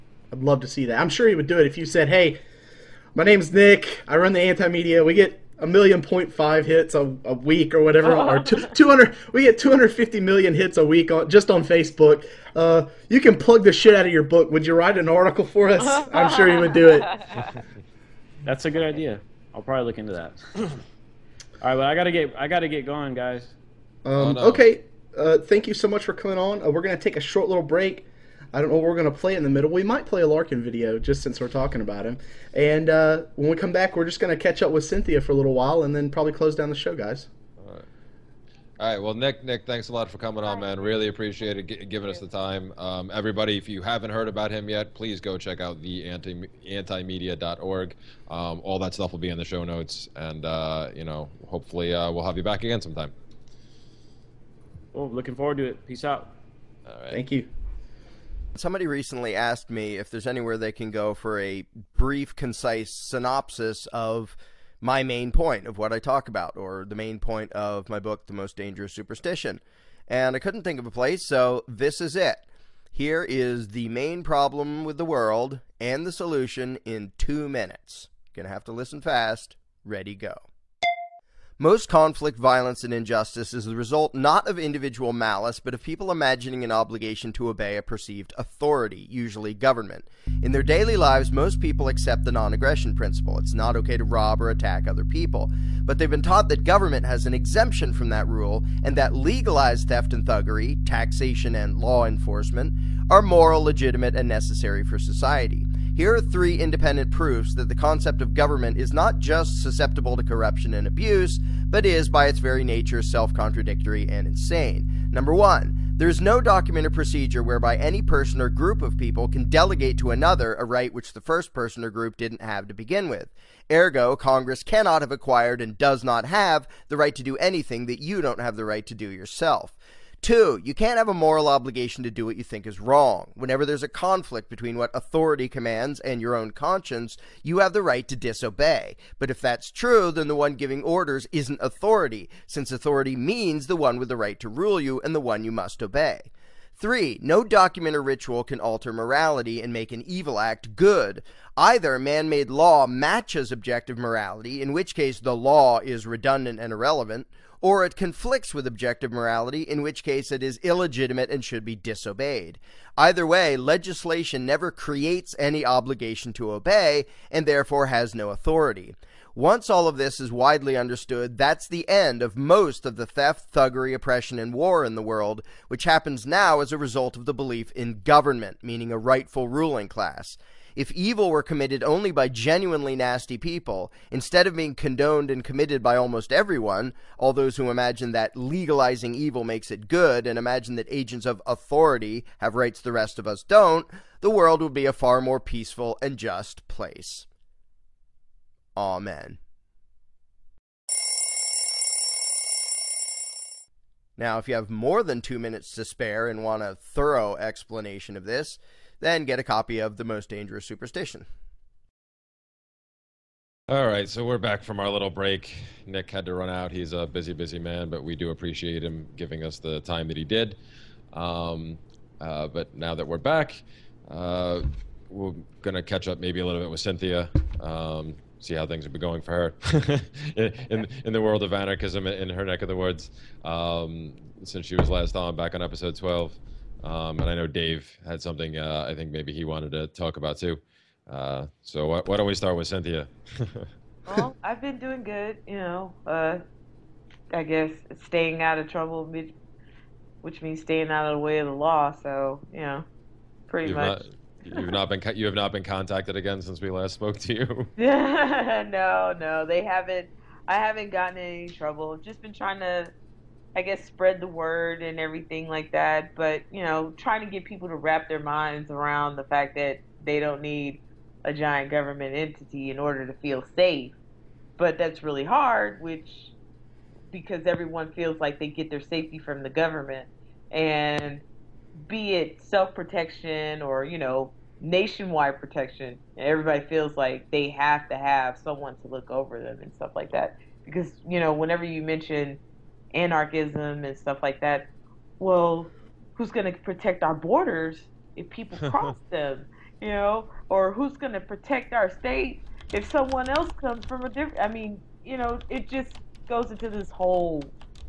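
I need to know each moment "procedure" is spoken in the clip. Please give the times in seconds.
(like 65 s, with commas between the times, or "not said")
116 s.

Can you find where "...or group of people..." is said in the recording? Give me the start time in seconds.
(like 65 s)
118 s.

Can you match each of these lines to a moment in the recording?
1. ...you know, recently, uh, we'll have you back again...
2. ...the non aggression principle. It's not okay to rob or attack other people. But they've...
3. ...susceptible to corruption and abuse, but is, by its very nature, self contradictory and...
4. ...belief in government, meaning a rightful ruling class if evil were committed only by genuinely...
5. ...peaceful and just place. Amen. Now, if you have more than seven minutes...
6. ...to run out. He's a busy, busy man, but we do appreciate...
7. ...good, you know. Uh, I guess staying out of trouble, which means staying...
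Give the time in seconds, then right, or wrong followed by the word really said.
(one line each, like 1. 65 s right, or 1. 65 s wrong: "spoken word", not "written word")
1. 50 s wrong: "hopefully", not "recently"
2. 92 s right
3. 109 s right
4. 177 s right
5. 195 s wrong: "two", not "seven"
6. 216 s right
7. 245 s right.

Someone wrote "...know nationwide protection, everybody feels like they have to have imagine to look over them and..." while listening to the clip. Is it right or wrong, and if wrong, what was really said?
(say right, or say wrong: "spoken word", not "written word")
wrong: "someone", not "imagine".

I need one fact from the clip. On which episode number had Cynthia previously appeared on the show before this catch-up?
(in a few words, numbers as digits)
12.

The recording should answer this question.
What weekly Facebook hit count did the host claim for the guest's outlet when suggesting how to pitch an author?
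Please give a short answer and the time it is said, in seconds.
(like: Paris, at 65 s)
250 million, at 9 s.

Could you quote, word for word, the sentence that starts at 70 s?
And I couldn't think of a place, so this is it.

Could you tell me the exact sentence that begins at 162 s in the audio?
Either way, legislation never creates any obligation to obey, and therefore has no authority.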